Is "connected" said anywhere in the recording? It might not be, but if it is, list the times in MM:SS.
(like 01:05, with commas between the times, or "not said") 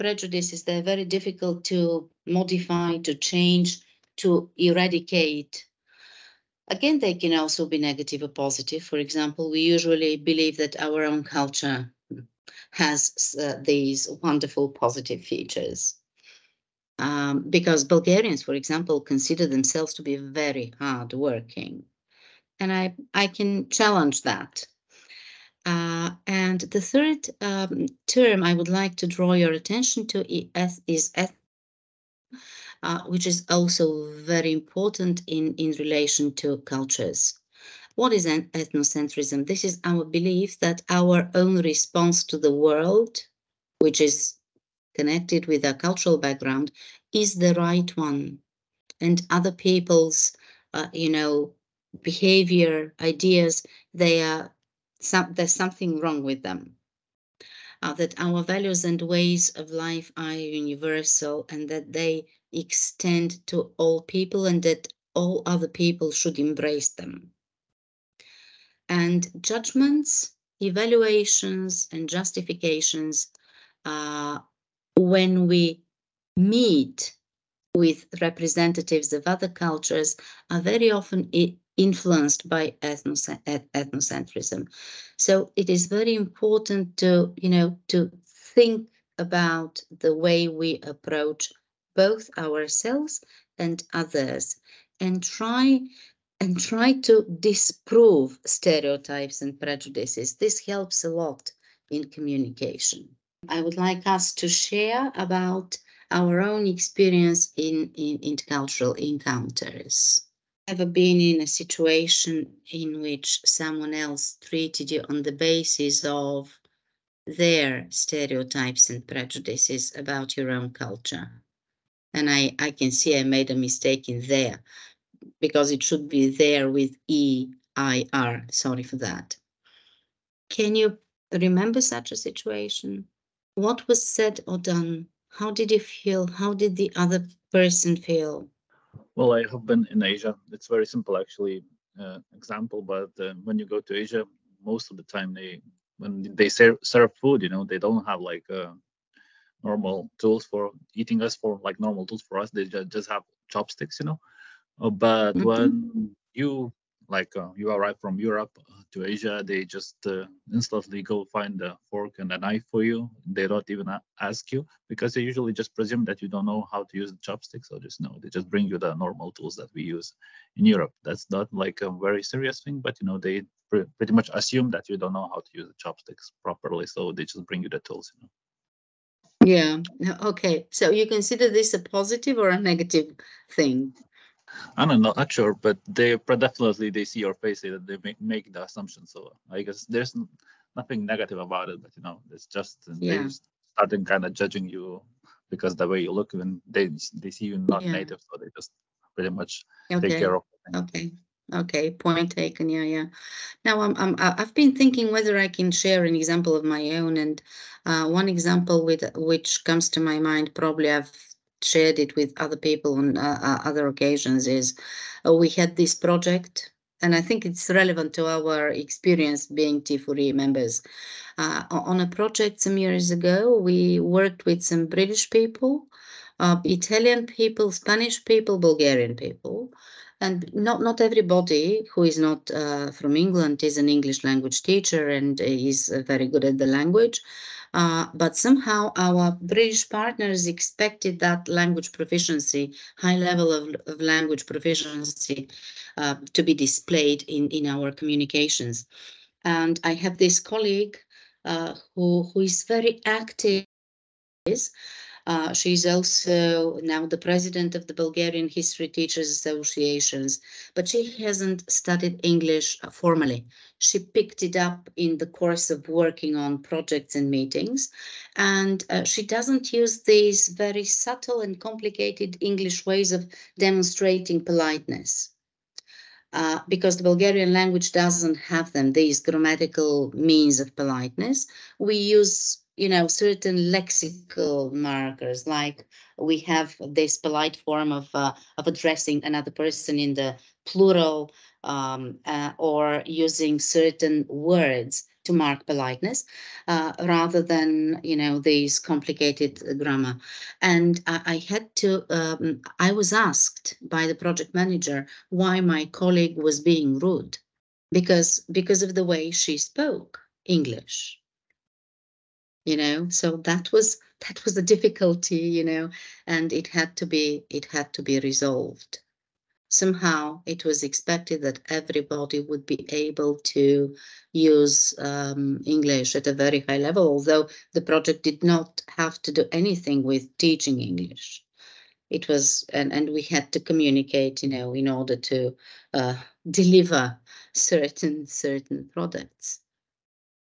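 00:44.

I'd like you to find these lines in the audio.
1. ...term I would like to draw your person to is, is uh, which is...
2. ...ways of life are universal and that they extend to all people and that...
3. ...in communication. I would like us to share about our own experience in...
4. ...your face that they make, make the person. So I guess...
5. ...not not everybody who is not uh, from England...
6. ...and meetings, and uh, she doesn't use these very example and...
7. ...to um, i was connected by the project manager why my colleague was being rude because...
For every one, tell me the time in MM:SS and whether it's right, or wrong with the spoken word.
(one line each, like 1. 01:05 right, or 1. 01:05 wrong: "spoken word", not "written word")
1. 00:28 wrong: "attention", not "person"
2. 00:59 right
3. 01:41 right
4. 03:07 wrong: "assumption", not "person"
5. 03:50 right
6. 04:27 wrong: "subtle", not "example"
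7. 05:01 wrong: "asked", not "connected".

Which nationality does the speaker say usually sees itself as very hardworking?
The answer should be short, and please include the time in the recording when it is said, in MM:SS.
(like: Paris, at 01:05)
Bulgarians, at 00:17.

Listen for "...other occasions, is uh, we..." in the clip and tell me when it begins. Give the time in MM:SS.
03:33.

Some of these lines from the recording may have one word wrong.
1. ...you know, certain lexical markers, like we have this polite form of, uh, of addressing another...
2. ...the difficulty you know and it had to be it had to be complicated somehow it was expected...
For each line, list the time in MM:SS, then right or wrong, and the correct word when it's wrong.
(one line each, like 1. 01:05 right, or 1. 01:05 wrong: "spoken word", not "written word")
1. 04:42 right
2. 05:14 wrong: "resolved", not "complicated".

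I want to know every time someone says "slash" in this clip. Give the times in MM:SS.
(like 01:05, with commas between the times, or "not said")
not said.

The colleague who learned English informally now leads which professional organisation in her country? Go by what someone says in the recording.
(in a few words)
Bulgarian History Teachers Associations.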